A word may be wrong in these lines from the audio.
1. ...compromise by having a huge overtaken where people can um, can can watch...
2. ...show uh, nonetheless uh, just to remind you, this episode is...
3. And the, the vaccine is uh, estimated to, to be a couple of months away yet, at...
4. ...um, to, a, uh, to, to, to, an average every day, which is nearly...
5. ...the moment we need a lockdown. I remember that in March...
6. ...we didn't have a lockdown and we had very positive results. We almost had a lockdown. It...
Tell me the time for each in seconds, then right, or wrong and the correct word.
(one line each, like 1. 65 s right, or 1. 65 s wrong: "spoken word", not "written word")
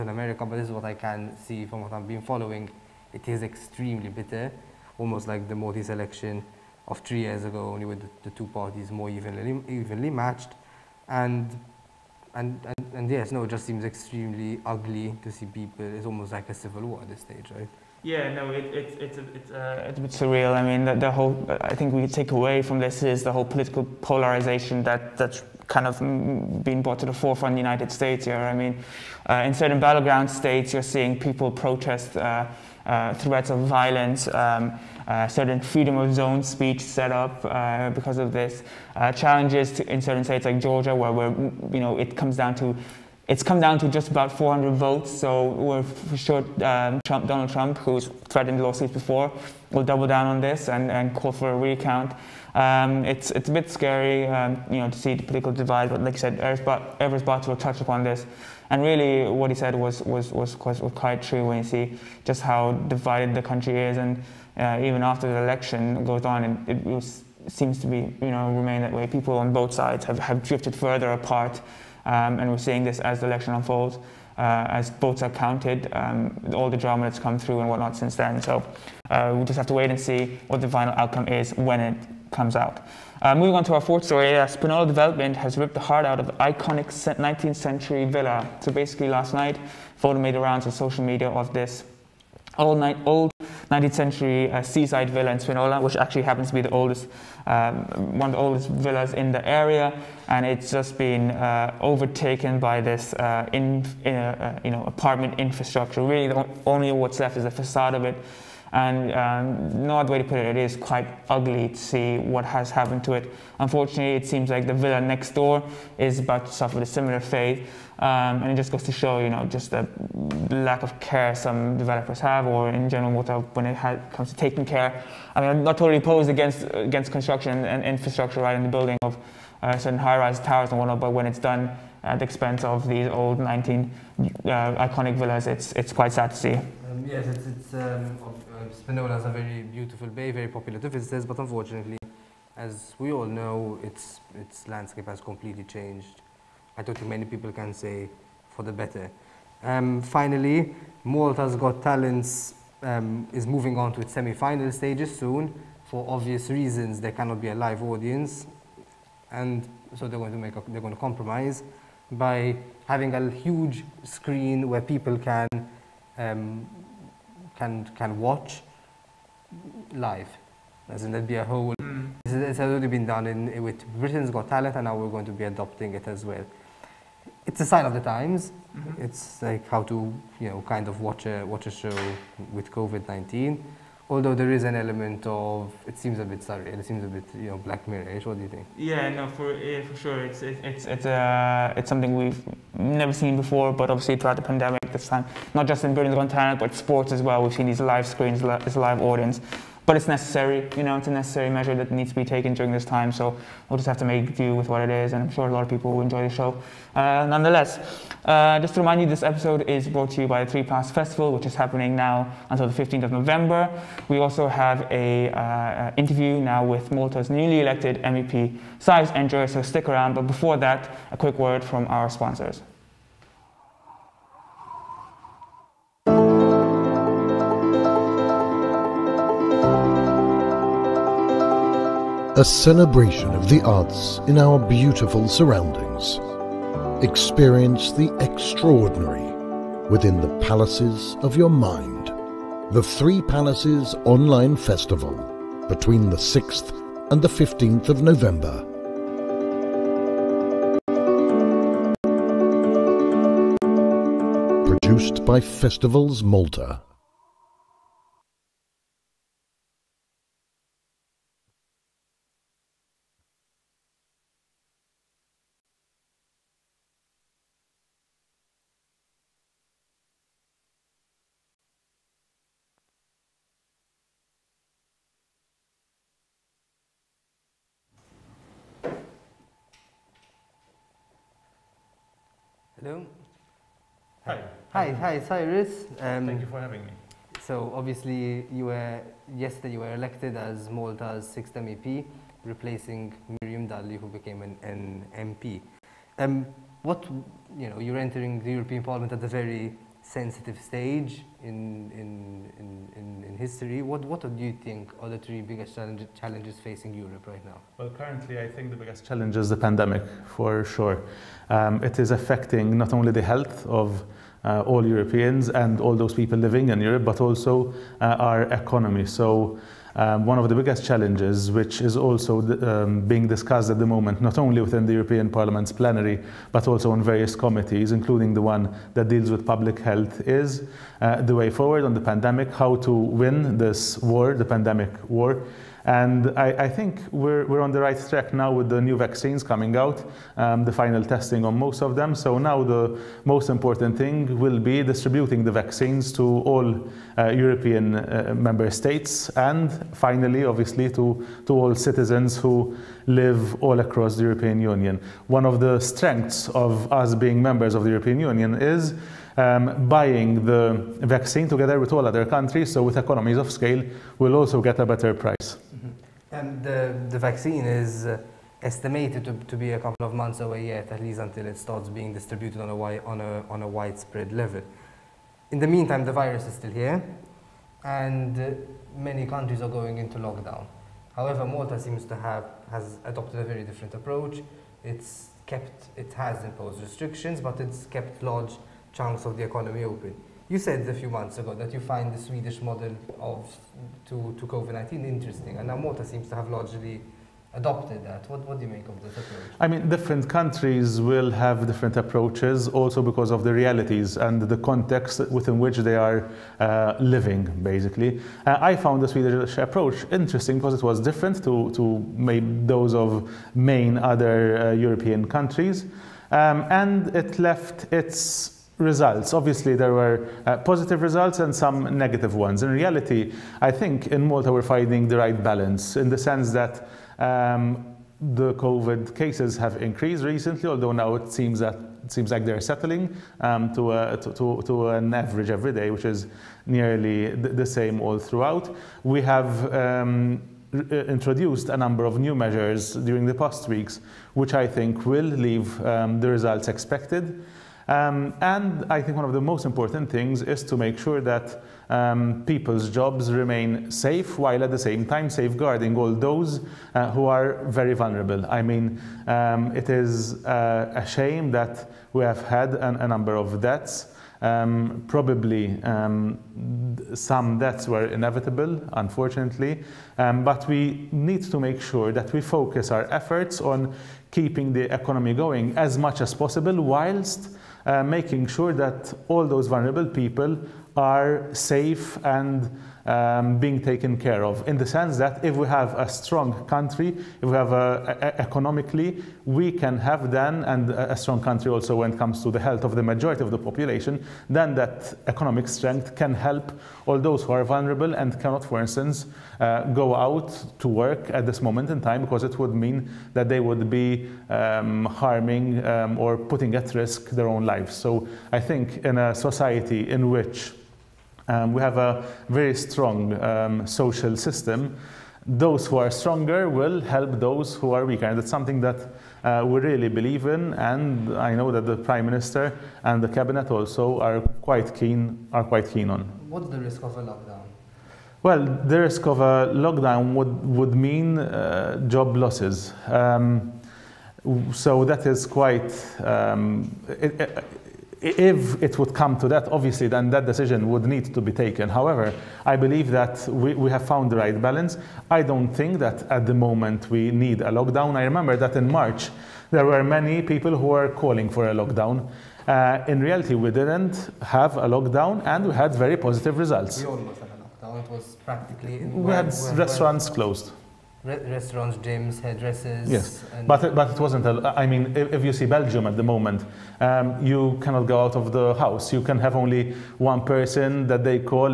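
1. 160 s wrong: "screen", not "overtaken"
2. 206 s right
3. 366 s right
4. 433 s right
5. 546 s right
6. 553 s right.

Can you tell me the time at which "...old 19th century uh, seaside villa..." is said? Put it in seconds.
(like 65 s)
93 s.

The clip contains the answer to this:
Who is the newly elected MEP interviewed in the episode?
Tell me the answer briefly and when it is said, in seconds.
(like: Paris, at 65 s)
Cyrus Engerer, at 218 s.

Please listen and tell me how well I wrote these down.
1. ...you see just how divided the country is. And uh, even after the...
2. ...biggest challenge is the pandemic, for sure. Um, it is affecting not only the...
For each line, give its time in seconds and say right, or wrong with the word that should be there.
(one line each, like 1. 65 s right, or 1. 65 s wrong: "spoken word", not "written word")
1. 61 s right
2. 308 s right.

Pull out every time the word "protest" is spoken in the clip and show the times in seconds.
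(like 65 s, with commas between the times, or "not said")
31 s.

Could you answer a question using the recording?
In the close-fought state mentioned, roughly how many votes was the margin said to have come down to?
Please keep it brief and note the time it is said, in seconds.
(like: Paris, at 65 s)
400, at 44 s.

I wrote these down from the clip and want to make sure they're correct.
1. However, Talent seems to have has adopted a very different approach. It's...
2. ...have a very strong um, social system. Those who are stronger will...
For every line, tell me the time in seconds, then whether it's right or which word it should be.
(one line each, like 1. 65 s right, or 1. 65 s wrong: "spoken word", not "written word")
1. 381 s wrong: "Malta", not "Talent"
2. 511 s right.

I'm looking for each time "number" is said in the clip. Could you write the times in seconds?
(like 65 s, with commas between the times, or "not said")
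441 s, 463 s.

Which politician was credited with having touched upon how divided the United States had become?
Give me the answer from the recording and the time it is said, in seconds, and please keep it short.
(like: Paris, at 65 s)
Evarist Bartolo, at 56 s.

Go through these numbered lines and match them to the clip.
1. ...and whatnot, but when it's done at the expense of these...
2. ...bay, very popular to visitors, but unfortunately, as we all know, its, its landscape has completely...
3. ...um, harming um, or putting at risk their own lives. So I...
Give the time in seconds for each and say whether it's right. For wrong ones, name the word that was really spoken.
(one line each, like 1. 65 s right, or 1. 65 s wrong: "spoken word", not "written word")
1. 130 s right
2. 140 s right
3. 504 s right.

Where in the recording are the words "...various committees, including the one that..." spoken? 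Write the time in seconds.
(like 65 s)
326 s.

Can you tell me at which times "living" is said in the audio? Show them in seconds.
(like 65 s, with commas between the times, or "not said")
316 s, 406 s.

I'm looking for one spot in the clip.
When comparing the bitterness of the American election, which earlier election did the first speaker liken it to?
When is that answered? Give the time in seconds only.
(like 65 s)
5 s.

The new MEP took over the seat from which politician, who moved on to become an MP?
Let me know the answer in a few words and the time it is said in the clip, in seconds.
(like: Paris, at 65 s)
Miriam Dalli, at 293 s.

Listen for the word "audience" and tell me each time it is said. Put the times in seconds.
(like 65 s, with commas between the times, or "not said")
157 s, 199 s.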